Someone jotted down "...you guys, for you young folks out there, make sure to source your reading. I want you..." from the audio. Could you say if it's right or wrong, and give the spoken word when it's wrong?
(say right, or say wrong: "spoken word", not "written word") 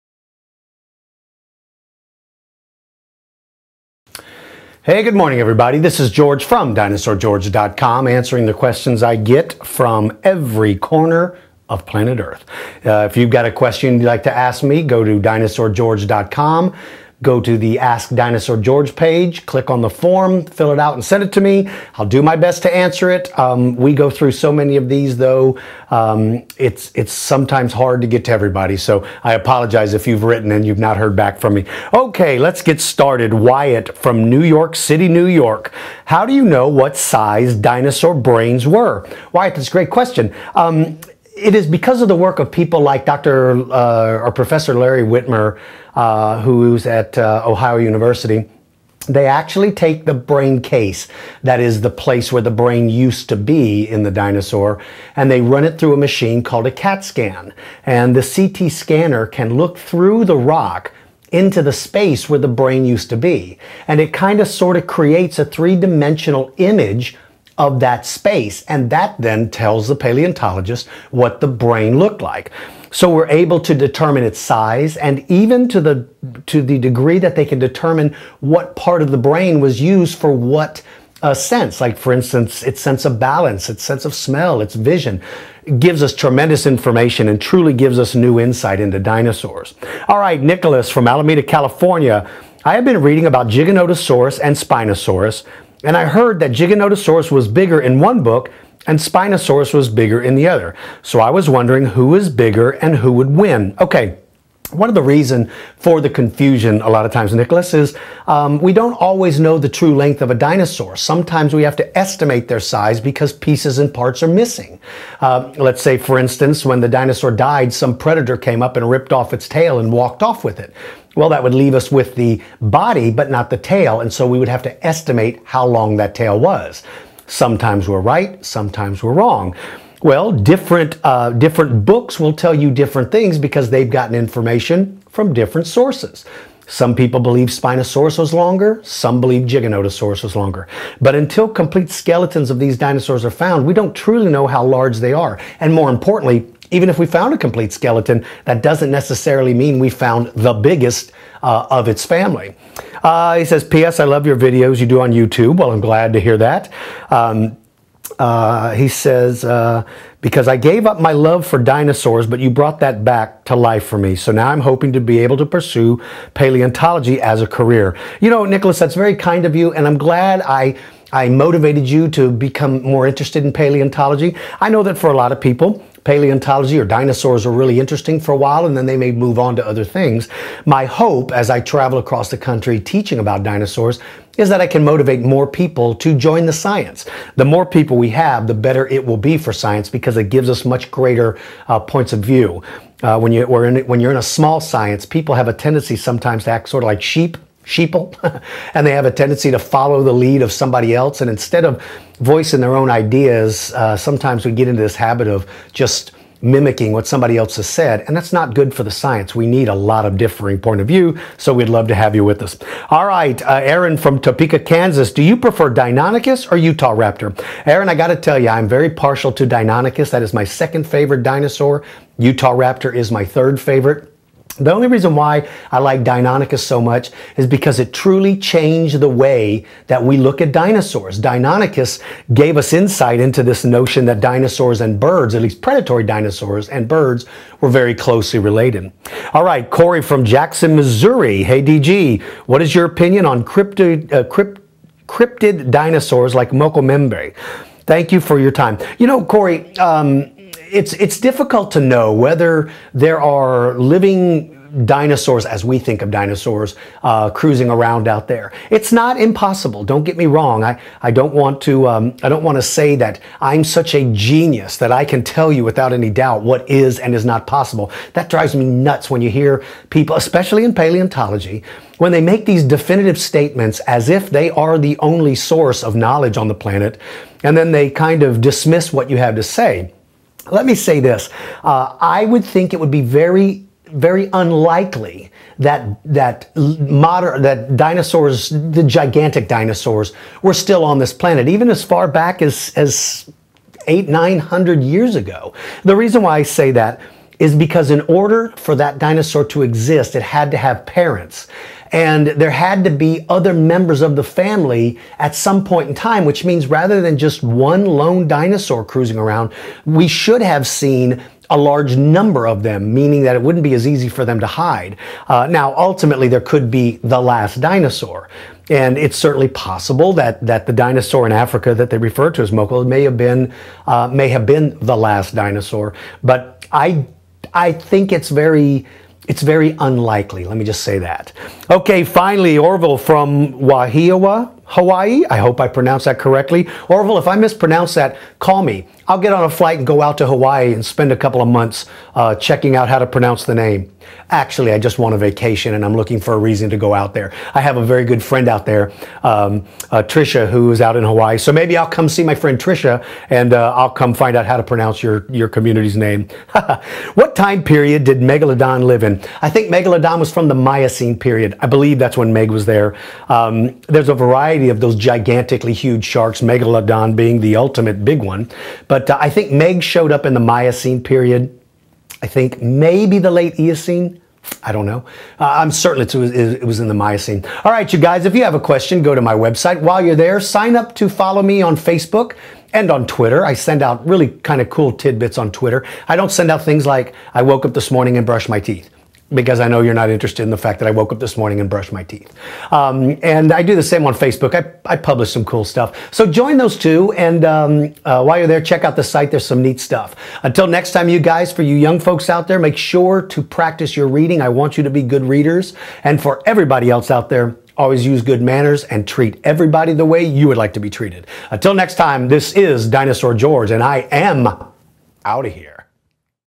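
wrong: "practice", not "source".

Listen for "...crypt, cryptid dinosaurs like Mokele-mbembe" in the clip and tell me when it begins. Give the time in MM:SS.
04:04.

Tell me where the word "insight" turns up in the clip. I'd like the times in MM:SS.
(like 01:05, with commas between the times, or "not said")
01:28, 03:52.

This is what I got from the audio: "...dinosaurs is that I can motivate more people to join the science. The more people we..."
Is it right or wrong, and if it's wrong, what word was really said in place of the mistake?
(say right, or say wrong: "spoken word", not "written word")
right.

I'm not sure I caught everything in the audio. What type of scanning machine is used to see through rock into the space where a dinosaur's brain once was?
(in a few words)
CAT scan.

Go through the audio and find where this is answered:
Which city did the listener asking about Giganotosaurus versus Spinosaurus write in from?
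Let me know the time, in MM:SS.
01:31.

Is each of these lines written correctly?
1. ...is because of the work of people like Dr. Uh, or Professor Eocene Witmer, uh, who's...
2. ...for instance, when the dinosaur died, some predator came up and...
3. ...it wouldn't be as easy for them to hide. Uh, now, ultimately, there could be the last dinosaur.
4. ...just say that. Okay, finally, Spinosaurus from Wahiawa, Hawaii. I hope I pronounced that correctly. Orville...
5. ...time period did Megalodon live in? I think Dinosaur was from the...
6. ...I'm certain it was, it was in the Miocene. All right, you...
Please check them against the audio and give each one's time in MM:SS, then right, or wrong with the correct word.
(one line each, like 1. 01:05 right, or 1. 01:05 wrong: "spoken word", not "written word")
1. 00:41 wrong: "Larry", not "Eocene"
2. 01:55 right
3. 05:13 right
4. 05:30 wrong: "Orville", not "Spinosaurus"
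5. 05:57 wrong: "Megalodon", not "Dinosaur"
6. 06:15 right.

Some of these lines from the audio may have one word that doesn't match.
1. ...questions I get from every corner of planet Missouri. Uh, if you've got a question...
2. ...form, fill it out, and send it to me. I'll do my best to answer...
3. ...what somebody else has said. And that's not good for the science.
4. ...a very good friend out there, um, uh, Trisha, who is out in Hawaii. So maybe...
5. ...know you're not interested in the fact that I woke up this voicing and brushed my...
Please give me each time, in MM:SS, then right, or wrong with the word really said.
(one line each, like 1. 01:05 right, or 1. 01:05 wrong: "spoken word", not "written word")
1. 00:08 wrong: "Earth", not "Missouri"
2. 00:19 right
3. 03:26 right
4. 05:47 right
5. 06:29 wrong: "morning", not "voicing".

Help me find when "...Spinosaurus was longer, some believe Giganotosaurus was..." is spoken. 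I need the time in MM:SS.
02:17.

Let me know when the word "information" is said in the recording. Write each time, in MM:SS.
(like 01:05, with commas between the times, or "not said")
01:26, 02:14.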